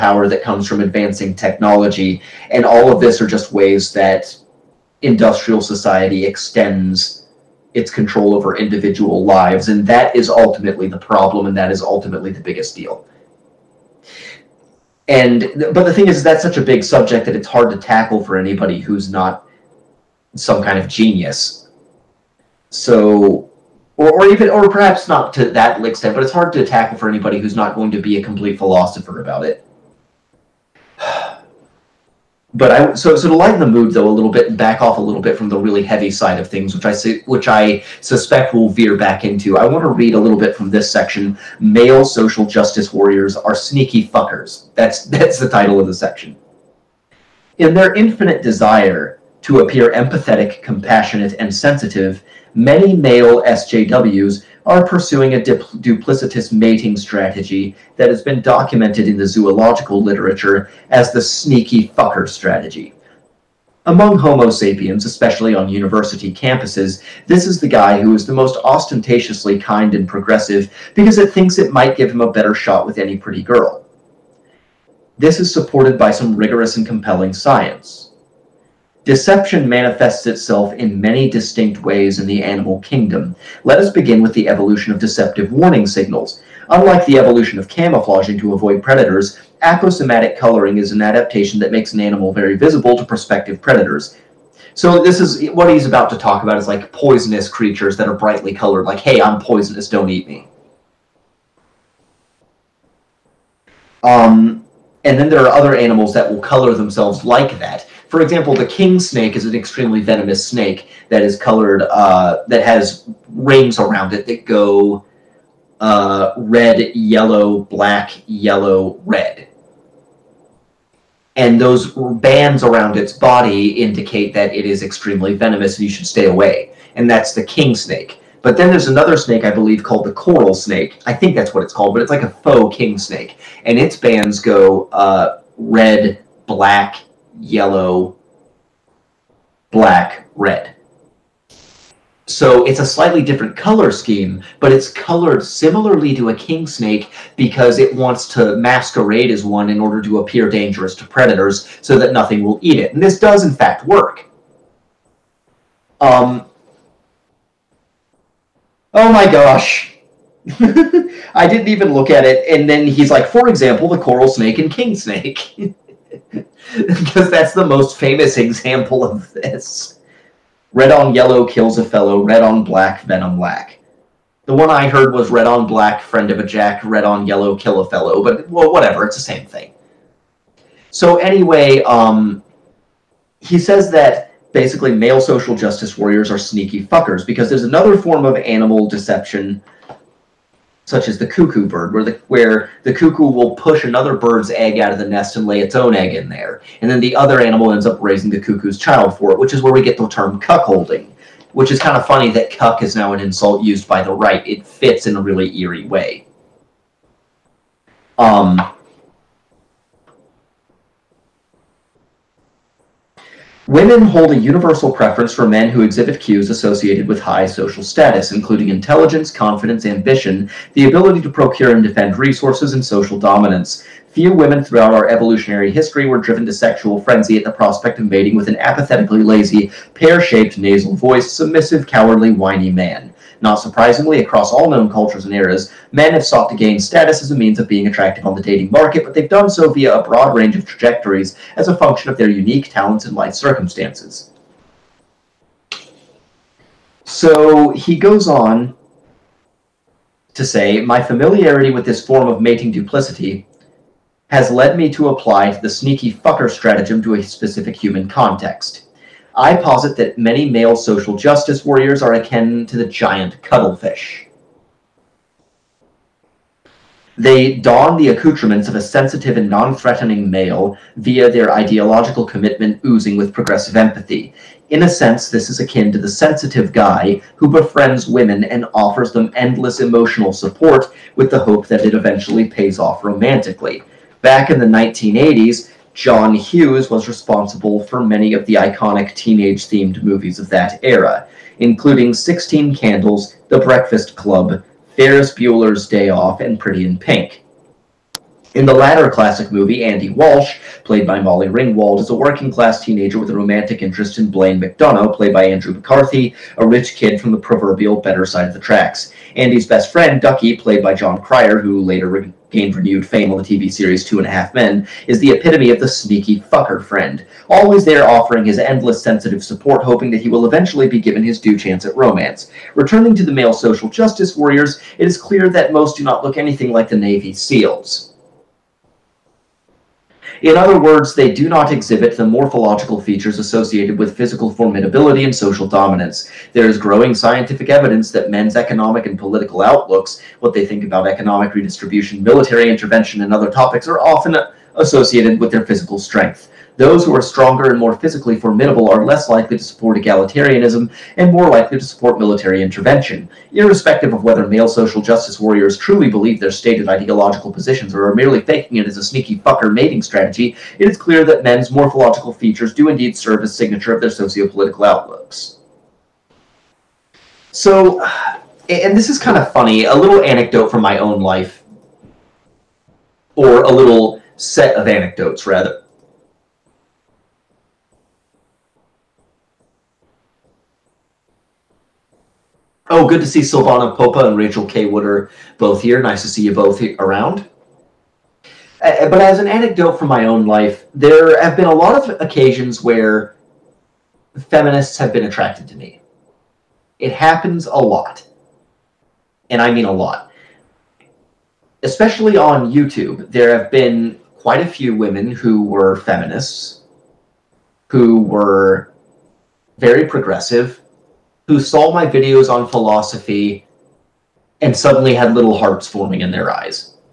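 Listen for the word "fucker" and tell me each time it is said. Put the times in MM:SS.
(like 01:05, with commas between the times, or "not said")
00:44, 01:01, 03:06, 04:16, 05:16, 05:59.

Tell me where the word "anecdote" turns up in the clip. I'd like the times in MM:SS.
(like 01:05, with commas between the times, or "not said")
06:10, 06:14, 06:29.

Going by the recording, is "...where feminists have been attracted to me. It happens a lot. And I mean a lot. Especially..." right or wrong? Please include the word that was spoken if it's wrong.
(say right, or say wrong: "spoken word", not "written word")
right.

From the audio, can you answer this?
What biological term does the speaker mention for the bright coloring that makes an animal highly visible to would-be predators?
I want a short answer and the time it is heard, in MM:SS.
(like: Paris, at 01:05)
Aposematic coloring, at 01:29.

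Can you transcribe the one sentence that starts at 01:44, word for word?
Um, and then there are other animals that will color themselves like that.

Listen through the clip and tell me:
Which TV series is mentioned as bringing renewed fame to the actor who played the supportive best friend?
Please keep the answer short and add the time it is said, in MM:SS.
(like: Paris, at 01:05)
Two and a Half Men, at 05:14.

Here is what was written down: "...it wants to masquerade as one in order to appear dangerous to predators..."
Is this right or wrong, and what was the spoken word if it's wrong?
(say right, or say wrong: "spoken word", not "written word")
right.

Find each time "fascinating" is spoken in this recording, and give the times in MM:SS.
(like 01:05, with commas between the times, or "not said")
not said.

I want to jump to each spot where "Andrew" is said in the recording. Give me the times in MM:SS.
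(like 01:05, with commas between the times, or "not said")
05:05.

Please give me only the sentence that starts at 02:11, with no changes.
I think that's what it's called, but it's like a faux king snake.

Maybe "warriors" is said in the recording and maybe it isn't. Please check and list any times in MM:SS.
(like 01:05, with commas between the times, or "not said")
00:42, 03:05, 04:21, 05:24, 05:55.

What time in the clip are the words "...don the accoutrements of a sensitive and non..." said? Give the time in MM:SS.
04:27.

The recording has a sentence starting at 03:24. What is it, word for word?
It fits in a really eerie way.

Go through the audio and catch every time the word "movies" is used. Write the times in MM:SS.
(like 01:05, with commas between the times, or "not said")
04:50, 04:59.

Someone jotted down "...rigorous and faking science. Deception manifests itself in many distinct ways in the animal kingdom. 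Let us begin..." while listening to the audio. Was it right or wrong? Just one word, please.
wrong.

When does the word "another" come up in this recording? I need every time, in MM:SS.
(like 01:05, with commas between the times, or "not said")
02:08, 03:07, 03:13.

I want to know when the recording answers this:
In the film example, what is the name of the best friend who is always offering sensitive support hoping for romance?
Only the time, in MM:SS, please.
05:10.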